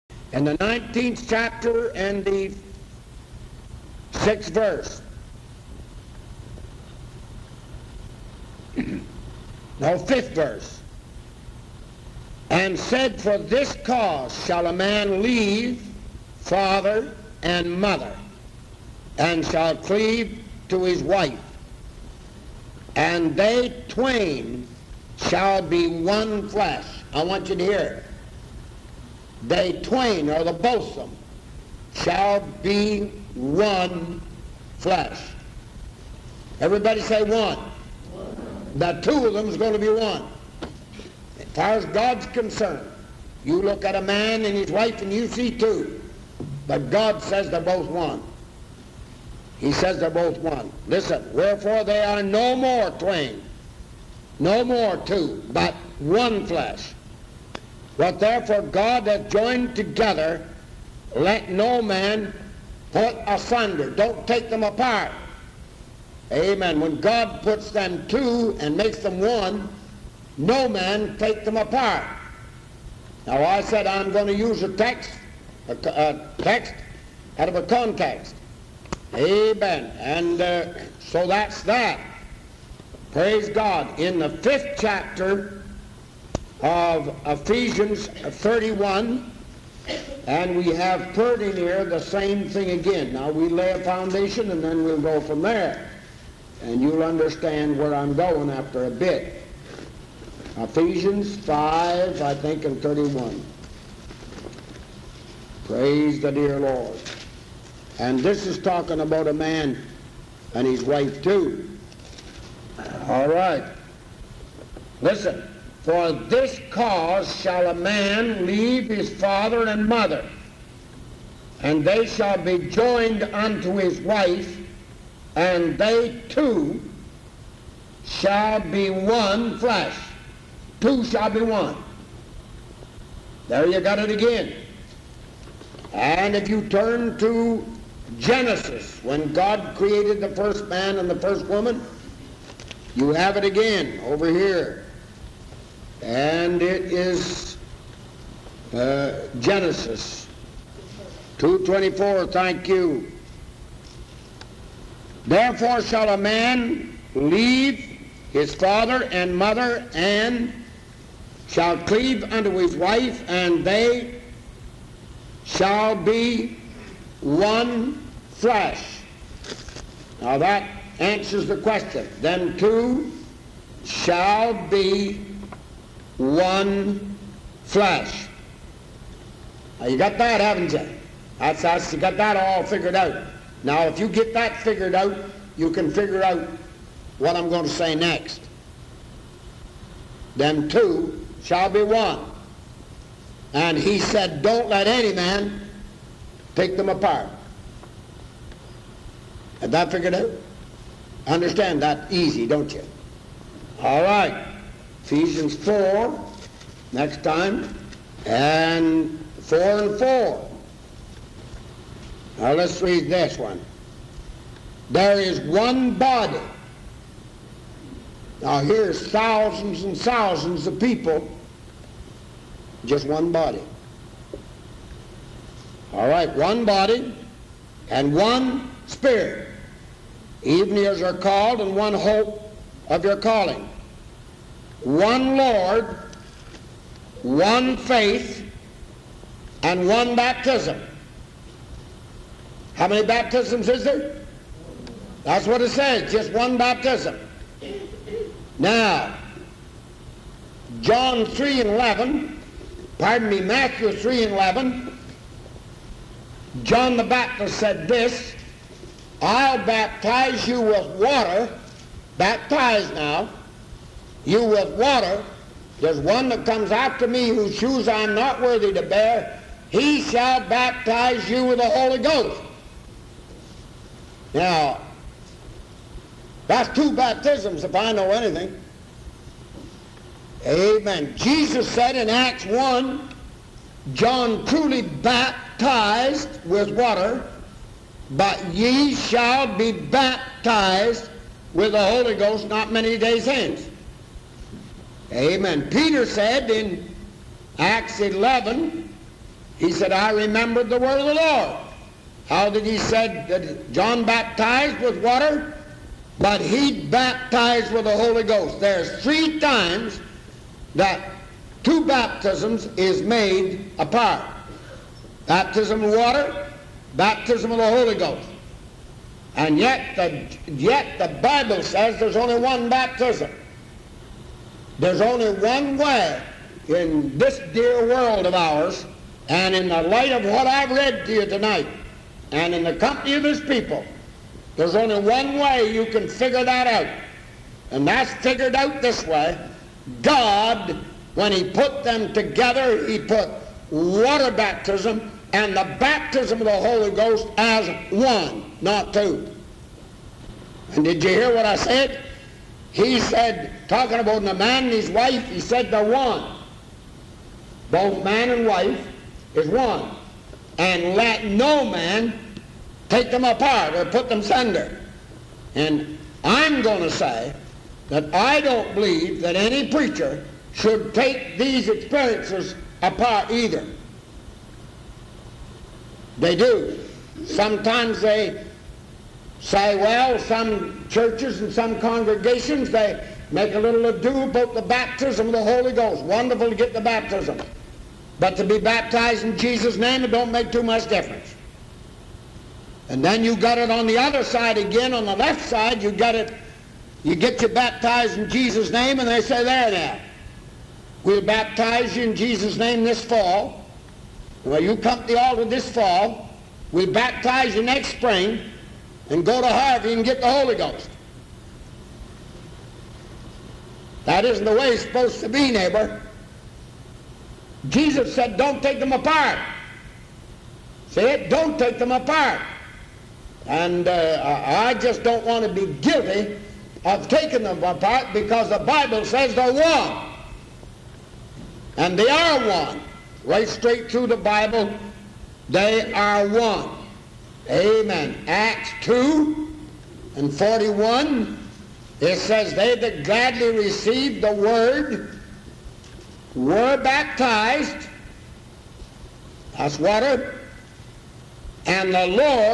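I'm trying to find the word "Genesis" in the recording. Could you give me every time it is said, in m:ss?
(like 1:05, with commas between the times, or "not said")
2:18, 2:29.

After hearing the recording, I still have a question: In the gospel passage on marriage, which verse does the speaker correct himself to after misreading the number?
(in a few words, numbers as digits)
5th verse.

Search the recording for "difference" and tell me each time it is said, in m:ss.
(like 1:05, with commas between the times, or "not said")
6:30.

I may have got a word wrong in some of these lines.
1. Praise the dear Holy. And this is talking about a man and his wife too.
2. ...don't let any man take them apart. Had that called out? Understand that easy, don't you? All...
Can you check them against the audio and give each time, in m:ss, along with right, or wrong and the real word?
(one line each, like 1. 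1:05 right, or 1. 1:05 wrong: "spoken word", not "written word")
1. 1:45 wrong: "Lord", not "Holy"
2. 3:14 wrong: "figured", not "called".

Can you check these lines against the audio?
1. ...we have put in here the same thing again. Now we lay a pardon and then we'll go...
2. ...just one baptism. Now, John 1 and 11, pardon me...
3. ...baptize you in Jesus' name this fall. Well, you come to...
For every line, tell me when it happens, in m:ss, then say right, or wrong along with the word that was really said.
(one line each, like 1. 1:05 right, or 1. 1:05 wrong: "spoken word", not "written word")
1. 1:30 wrong: "foundation", not "pardon"
2. 4:06 wrong: "3", not "1"
3. 6:41 right.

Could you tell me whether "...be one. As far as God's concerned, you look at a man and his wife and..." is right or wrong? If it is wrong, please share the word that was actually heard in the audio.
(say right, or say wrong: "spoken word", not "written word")
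right.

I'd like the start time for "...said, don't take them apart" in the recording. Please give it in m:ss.
6:58.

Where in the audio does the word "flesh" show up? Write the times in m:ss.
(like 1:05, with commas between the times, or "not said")
0:26, 0:34, 0:56, 2:09, 2:48.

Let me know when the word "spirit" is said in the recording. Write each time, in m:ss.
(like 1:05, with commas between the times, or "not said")
3:48.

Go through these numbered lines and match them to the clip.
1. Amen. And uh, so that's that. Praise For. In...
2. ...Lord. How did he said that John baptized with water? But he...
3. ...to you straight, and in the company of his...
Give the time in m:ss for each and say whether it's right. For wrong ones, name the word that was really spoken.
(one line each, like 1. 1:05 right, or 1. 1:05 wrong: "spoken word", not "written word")
1. 1:19 wrong: "God", not "For"
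2. 5:01 right
3. 5:31 wrong: "tonight", not "straight".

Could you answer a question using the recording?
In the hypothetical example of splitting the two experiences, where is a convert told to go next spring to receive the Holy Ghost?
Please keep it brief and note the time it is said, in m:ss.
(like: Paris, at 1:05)
Harvey, at 6:49.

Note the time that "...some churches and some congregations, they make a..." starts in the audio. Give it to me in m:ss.
6:20.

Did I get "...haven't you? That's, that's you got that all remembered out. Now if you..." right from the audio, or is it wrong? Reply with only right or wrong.
wrong.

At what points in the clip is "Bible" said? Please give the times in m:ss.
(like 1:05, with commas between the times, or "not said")
5:21, 7:08, 7:14.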